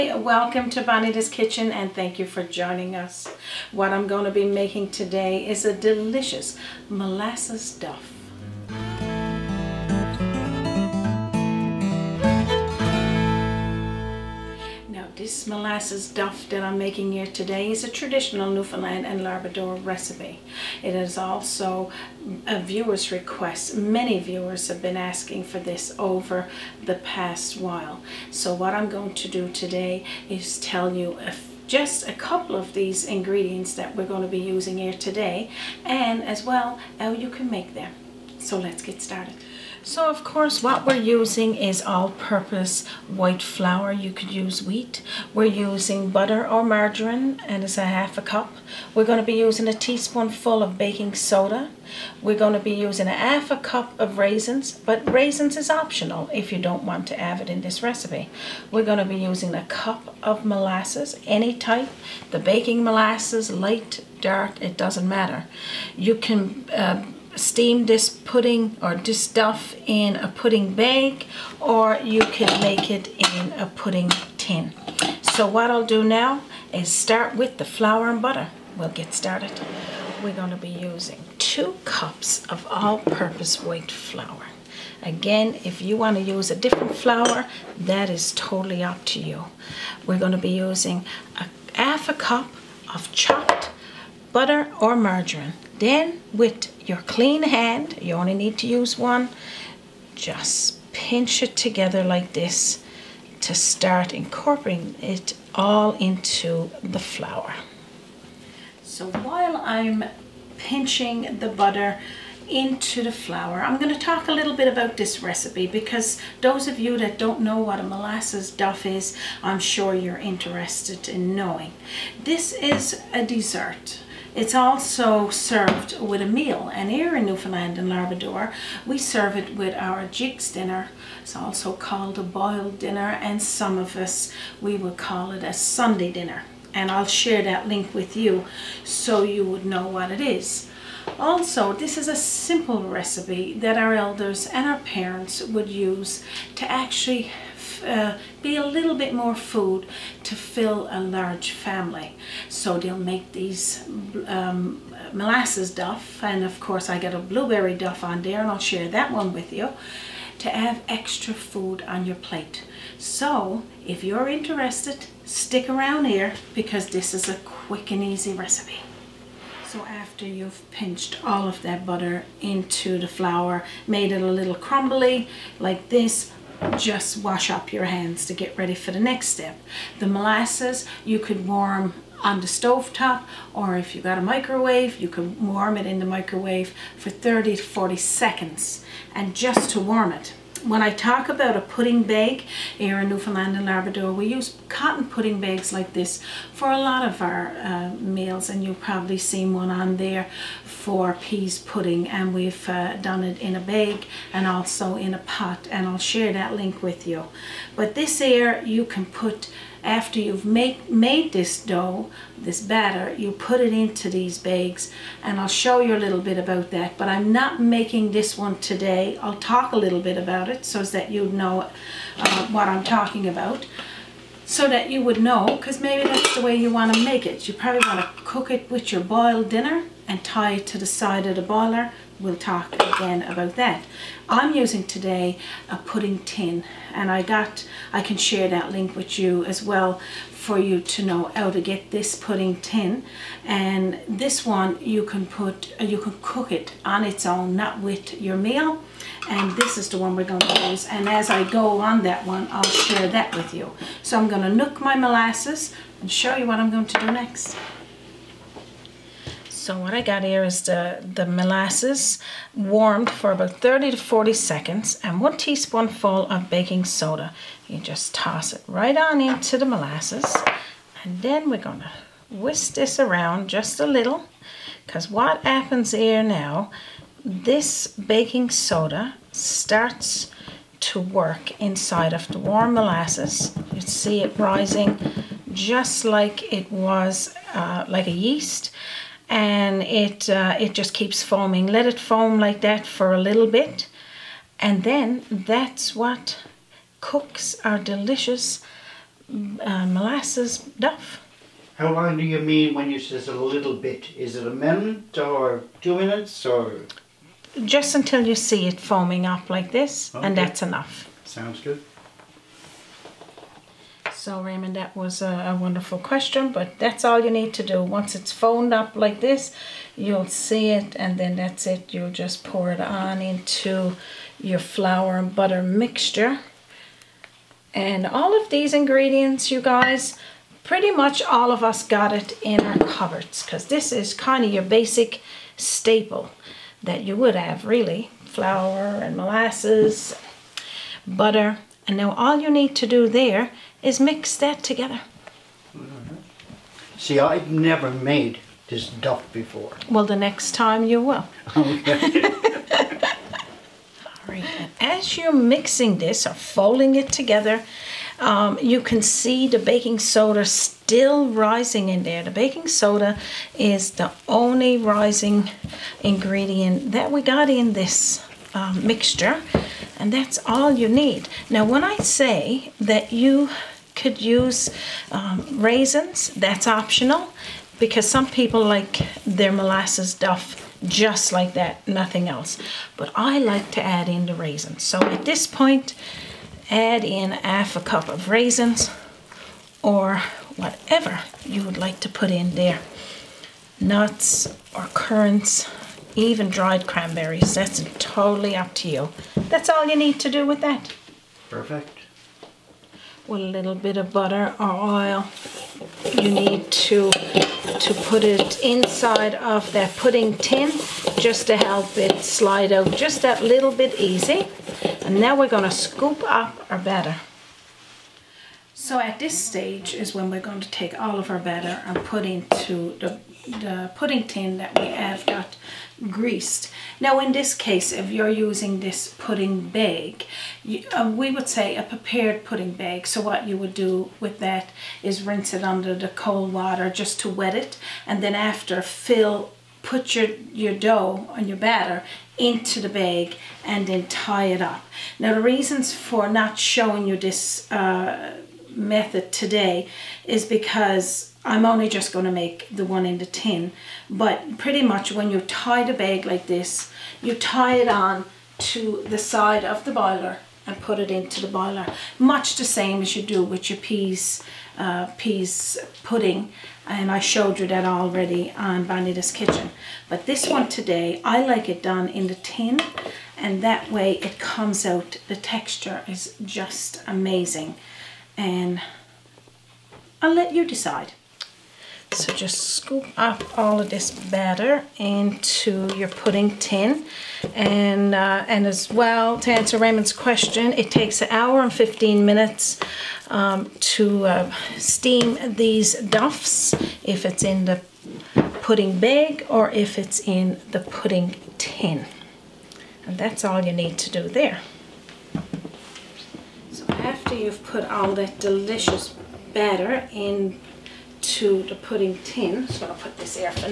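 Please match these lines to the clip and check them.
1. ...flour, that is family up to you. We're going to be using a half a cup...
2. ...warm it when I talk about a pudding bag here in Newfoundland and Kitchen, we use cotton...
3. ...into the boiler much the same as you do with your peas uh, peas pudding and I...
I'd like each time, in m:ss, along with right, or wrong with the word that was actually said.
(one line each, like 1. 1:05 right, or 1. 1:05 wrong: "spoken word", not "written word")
1. 1:26 wrong: "totally", not "family"
2. 3:09 wrong: "Labrador", not "Kitchen"
3. 7:41 right.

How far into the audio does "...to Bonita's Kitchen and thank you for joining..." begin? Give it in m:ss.
0:00.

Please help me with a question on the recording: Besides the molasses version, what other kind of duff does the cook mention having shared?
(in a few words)
blueberry duff.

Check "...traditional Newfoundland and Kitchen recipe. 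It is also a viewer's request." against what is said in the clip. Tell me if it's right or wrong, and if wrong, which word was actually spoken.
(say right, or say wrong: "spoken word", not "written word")
wrong: "Labrador", not "Kitchen".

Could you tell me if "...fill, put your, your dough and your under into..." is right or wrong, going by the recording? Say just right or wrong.
wrong.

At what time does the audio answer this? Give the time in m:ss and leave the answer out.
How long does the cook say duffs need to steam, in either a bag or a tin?
8:11.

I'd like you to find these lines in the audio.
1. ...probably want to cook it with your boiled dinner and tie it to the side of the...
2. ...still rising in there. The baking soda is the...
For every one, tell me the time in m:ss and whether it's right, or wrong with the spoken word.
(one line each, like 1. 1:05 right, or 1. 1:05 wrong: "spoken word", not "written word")
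1. 3:47 right
2. 6:00 right.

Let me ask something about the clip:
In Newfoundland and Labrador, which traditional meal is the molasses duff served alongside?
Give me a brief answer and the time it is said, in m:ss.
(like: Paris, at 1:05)
jigs dinner, at 2:10.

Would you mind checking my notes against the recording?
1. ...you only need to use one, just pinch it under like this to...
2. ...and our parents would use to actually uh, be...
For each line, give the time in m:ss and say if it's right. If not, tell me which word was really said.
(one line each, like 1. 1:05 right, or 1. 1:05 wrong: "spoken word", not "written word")
1. 1:38 wrong: "together", not "under"
2. 2:24 right.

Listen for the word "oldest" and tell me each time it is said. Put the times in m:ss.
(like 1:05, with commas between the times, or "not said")
not said.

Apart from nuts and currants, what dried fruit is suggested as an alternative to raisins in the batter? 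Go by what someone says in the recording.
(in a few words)
dried cranberries.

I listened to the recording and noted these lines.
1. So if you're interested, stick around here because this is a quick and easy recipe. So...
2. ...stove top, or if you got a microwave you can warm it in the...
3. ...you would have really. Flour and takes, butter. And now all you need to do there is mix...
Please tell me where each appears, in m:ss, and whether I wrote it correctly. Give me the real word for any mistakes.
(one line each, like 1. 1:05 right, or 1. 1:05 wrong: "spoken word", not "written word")
1. 2:42 right
2. 3:02 right
3. 5:37 wrong: "molasses", not "takes".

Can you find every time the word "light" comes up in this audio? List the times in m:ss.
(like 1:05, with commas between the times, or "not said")
1:03.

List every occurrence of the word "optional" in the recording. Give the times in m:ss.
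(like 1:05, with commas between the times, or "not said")
0:55, 6:16.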